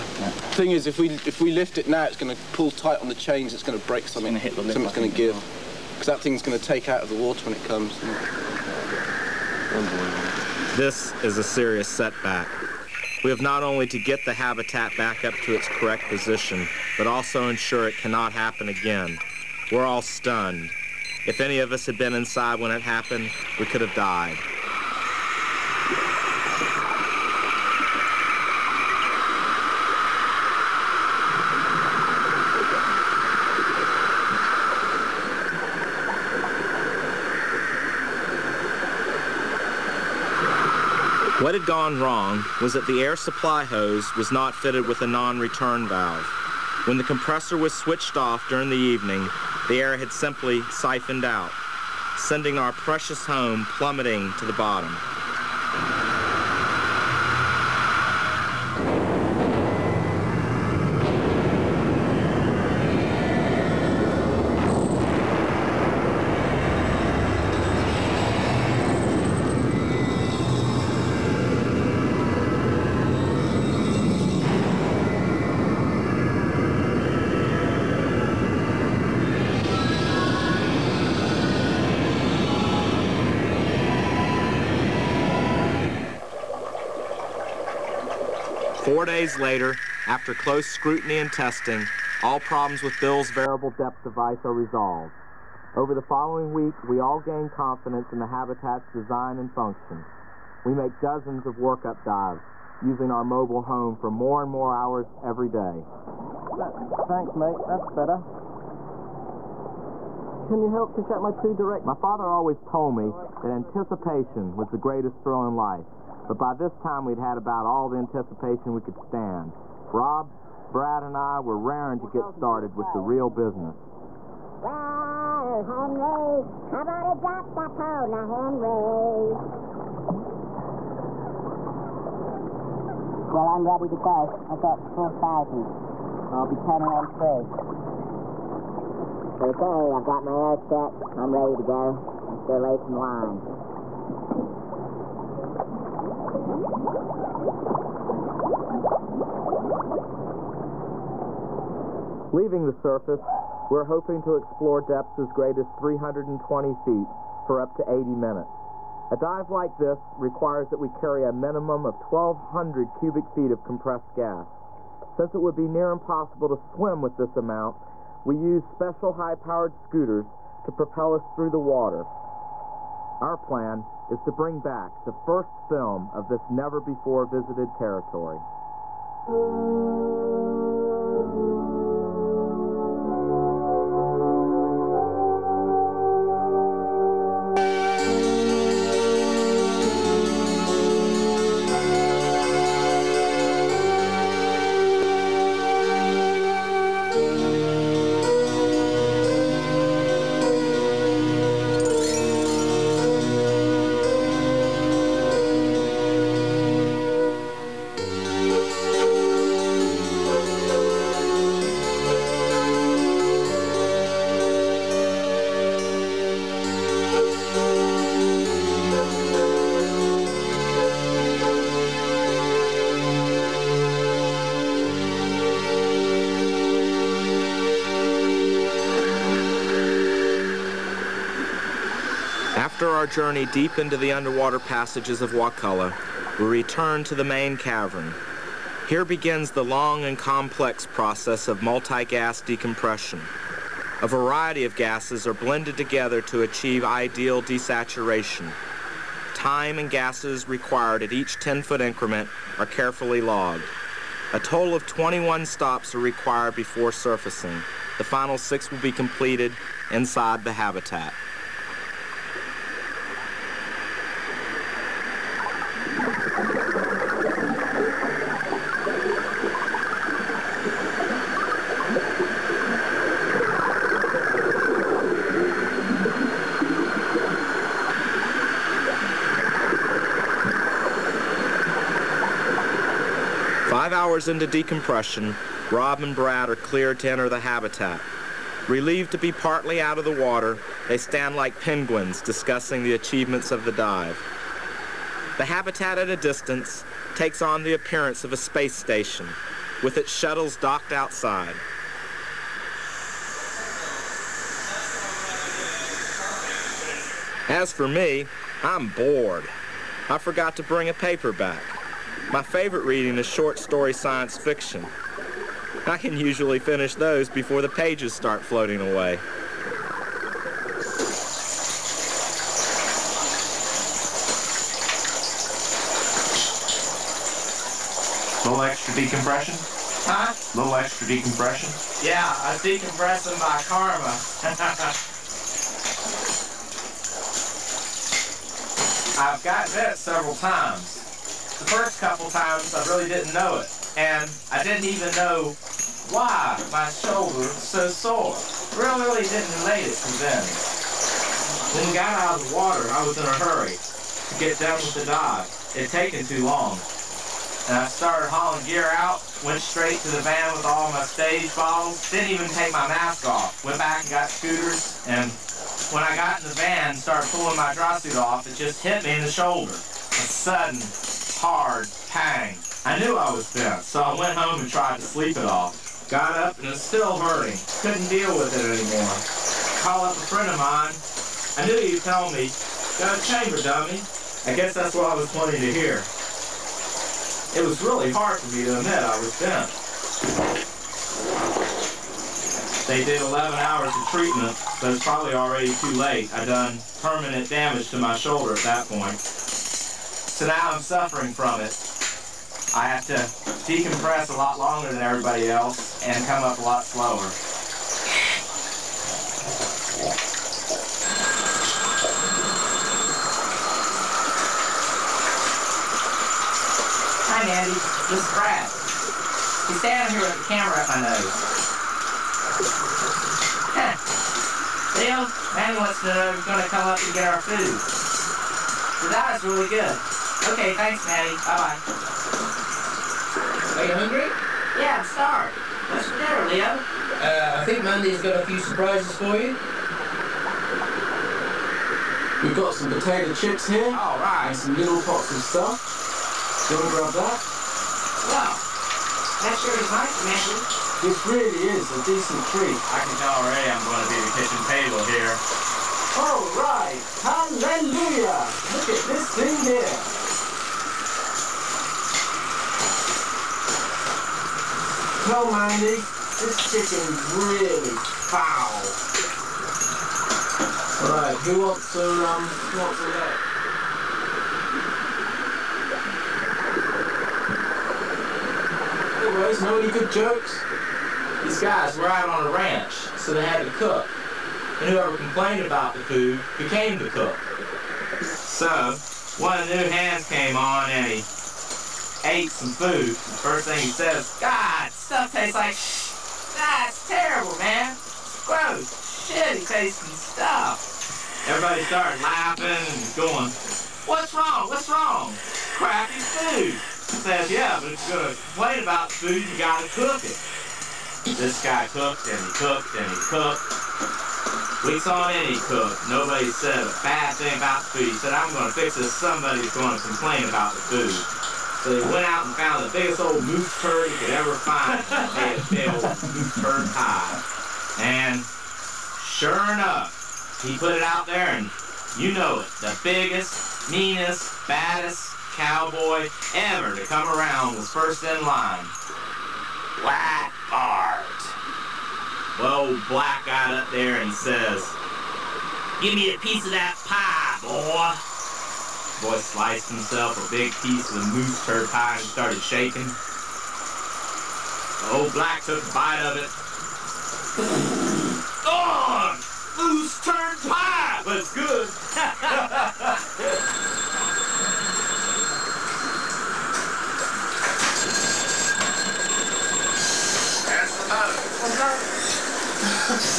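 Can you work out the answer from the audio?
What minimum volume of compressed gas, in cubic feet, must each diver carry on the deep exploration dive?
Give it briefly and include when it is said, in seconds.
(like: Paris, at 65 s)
1,200 cubic feet, at 161 s.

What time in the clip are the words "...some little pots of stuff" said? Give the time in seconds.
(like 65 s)
444 s.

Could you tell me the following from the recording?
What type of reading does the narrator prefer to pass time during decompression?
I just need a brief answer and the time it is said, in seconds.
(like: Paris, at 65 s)
short story science fiction, at 313 s.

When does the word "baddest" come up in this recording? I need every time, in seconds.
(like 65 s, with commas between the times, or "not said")
534 s.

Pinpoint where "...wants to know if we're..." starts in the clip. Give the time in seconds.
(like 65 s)
425 s.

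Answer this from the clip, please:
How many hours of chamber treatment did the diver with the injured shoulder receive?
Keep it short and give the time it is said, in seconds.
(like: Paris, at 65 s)
11 hours, at 393 s.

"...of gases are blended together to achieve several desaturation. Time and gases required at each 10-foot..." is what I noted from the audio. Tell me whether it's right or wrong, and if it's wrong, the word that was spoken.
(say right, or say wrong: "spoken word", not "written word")
wrong: "ideal", not "several".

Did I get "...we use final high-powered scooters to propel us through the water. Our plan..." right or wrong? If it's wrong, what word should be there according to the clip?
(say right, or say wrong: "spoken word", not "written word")
wrong: "special", not "final".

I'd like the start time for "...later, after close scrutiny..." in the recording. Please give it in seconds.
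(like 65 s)
89 s.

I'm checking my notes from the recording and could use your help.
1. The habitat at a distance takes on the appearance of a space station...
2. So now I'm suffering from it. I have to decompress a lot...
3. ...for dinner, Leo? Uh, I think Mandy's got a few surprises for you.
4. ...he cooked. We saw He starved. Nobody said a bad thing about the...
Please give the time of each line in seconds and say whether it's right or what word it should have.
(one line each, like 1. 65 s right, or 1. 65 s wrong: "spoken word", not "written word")
1. 295 s right
2. 400 s right
3. 436 s right
4. 513 s wrong: "cooked", not "starved".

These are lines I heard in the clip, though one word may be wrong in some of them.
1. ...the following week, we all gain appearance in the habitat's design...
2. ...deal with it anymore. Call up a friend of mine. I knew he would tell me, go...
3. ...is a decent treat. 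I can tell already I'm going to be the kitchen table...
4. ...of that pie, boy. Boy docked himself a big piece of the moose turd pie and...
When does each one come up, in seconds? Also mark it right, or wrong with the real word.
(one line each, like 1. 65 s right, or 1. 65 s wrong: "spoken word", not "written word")
1. 95 s wrong: "confidence", not "appearance"
2. 378 s right
3. 451 s right
4. 546 s wrong: "sliced", not "docked".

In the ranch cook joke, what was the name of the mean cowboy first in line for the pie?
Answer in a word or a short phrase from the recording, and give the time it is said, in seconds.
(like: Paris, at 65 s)
Black Bart, at 540 s.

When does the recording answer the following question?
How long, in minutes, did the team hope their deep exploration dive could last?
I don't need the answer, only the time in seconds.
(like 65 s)
157 s.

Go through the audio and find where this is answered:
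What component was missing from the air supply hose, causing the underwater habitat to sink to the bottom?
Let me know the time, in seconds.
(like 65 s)
45 s.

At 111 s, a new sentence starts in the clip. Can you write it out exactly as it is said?
My father always told me that anticipation was the greatest thrill in life.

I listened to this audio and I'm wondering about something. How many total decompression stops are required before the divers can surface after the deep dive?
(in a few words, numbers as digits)
21.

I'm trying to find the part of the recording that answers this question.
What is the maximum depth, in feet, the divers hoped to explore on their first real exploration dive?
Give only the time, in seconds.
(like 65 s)
155 s.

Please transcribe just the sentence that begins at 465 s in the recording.
Well, Mandy, this kitchen's really foul.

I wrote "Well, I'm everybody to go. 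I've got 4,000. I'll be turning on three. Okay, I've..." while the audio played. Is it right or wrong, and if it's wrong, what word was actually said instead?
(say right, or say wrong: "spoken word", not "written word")
wrong: "ready", not "everybody".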